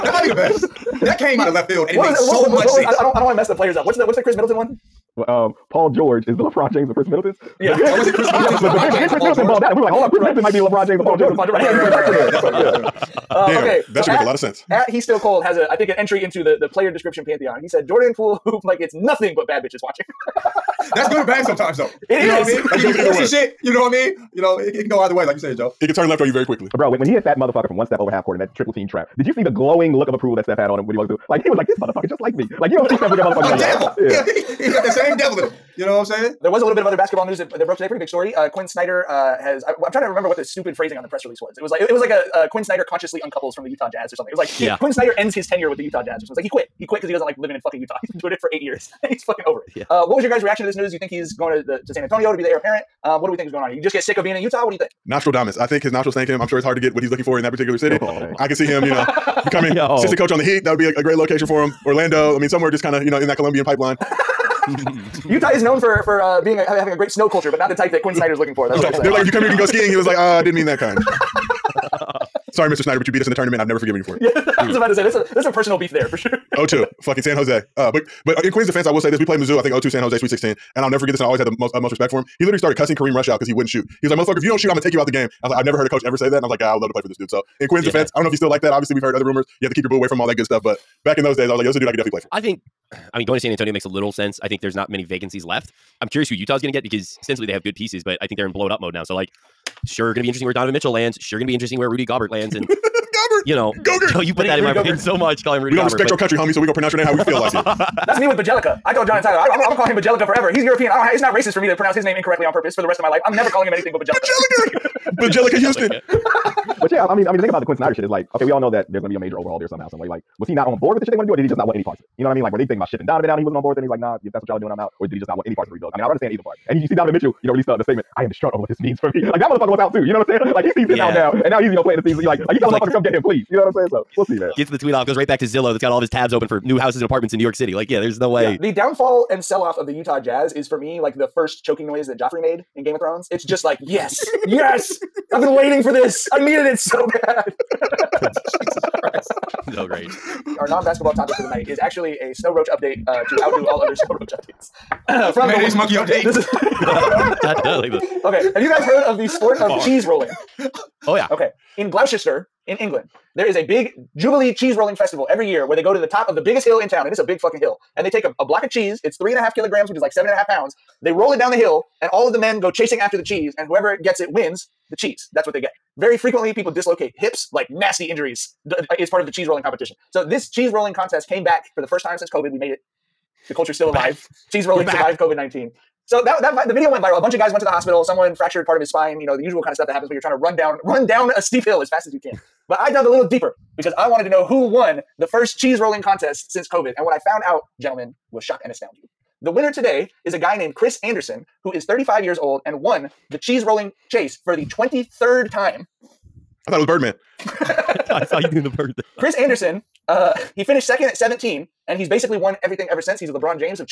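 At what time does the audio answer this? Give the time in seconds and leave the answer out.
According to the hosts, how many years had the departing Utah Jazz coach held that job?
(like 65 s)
48 s.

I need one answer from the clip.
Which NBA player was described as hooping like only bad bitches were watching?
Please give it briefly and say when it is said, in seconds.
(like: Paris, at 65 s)
Jordan Poole, at 17 s.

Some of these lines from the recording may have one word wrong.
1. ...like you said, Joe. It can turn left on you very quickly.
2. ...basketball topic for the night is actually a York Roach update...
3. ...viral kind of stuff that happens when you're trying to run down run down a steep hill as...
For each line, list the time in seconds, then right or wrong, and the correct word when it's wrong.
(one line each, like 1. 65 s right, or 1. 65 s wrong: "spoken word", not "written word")
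1. 25 s right
2. 150 s wrong: "Snow", not "York"
3. 189 s wrong: "usual", not "viral".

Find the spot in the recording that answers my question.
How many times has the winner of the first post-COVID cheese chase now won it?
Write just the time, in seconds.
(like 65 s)
204 s.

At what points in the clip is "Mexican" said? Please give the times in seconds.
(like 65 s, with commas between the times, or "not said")
not said.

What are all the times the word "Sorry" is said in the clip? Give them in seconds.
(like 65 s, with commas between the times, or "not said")
72 s.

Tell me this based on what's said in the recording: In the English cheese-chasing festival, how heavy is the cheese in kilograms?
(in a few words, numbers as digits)
3.5 kilograms.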